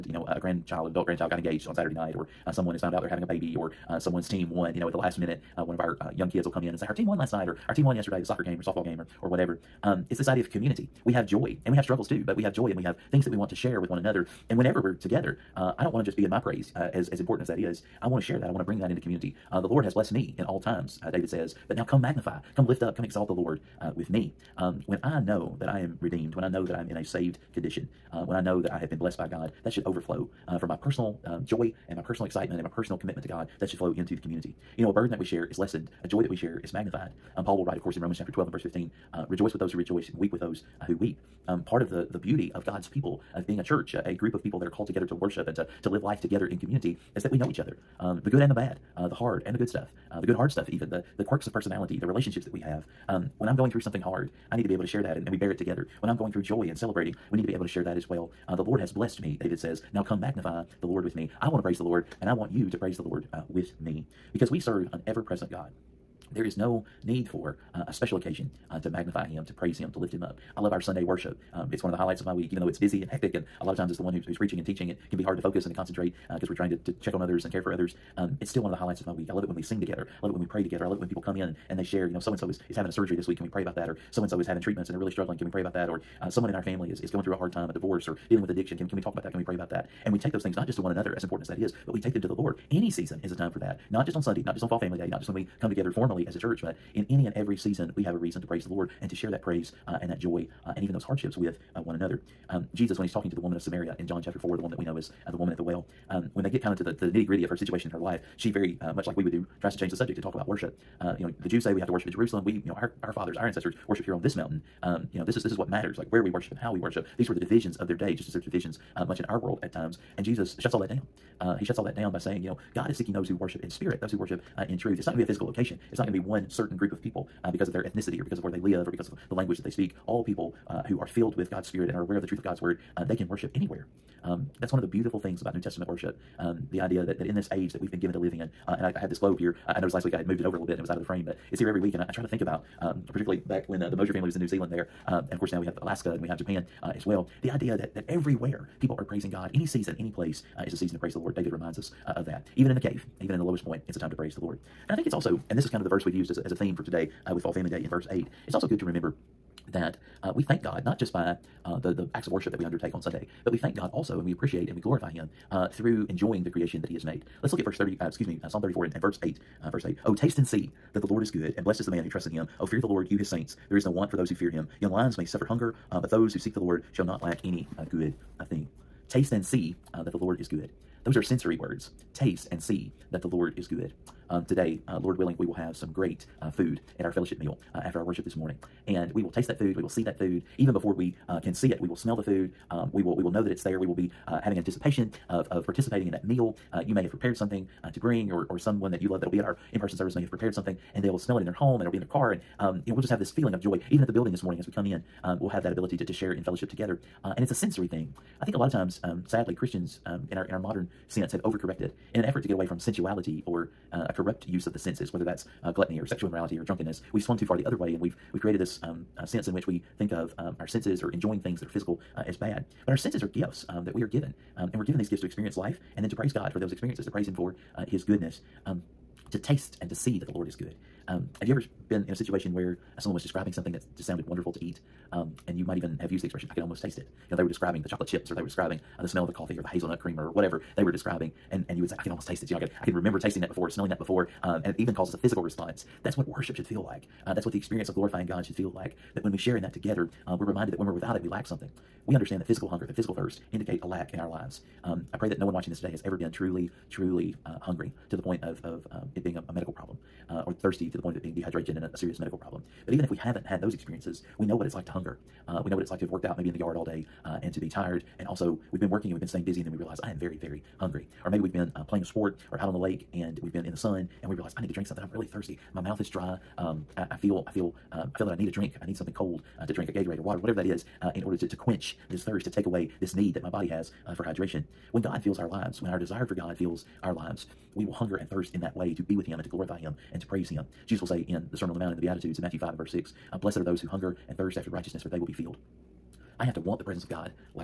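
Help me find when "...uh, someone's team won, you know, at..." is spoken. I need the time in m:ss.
0:03.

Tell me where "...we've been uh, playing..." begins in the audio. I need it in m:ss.
4:31.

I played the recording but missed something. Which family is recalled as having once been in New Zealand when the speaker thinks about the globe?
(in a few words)
Mosier.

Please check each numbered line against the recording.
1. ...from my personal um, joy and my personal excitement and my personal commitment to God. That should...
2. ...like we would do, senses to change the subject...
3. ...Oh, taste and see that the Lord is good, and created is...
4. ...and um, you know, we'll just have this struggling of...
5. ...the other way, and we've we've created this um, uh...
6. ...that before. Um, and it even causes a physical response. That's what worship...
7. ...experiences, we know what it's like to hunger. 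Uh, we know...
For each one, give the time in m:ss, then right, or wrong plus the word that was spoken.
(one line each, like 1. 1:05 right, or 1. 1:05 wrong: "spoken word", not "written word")
1. 0:30 right
2. 1:49 wrong: "tries", not "senses"
3. 2:50 wrong: "blessed", not "created"
4. 3:22 wrong: "feeling", not "struggling"
5. 3:37 right
6. 4:03 right
7. 4:23 right.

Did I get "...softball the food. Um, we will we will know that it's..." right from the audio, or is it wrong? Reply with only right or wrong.
wrong.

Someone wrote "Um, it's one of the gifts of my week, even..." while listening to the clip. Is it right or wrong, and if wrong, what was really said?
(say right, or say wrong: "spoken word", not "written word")
wrong: "highlights", not "gifts".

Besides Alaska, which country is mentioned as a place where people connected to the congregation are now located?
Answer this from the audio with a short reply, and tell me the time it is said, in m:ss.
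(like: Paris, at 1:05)
Japan, at 2:26.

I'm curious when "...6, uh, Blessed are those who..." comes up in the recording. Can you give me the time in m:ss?
4:52.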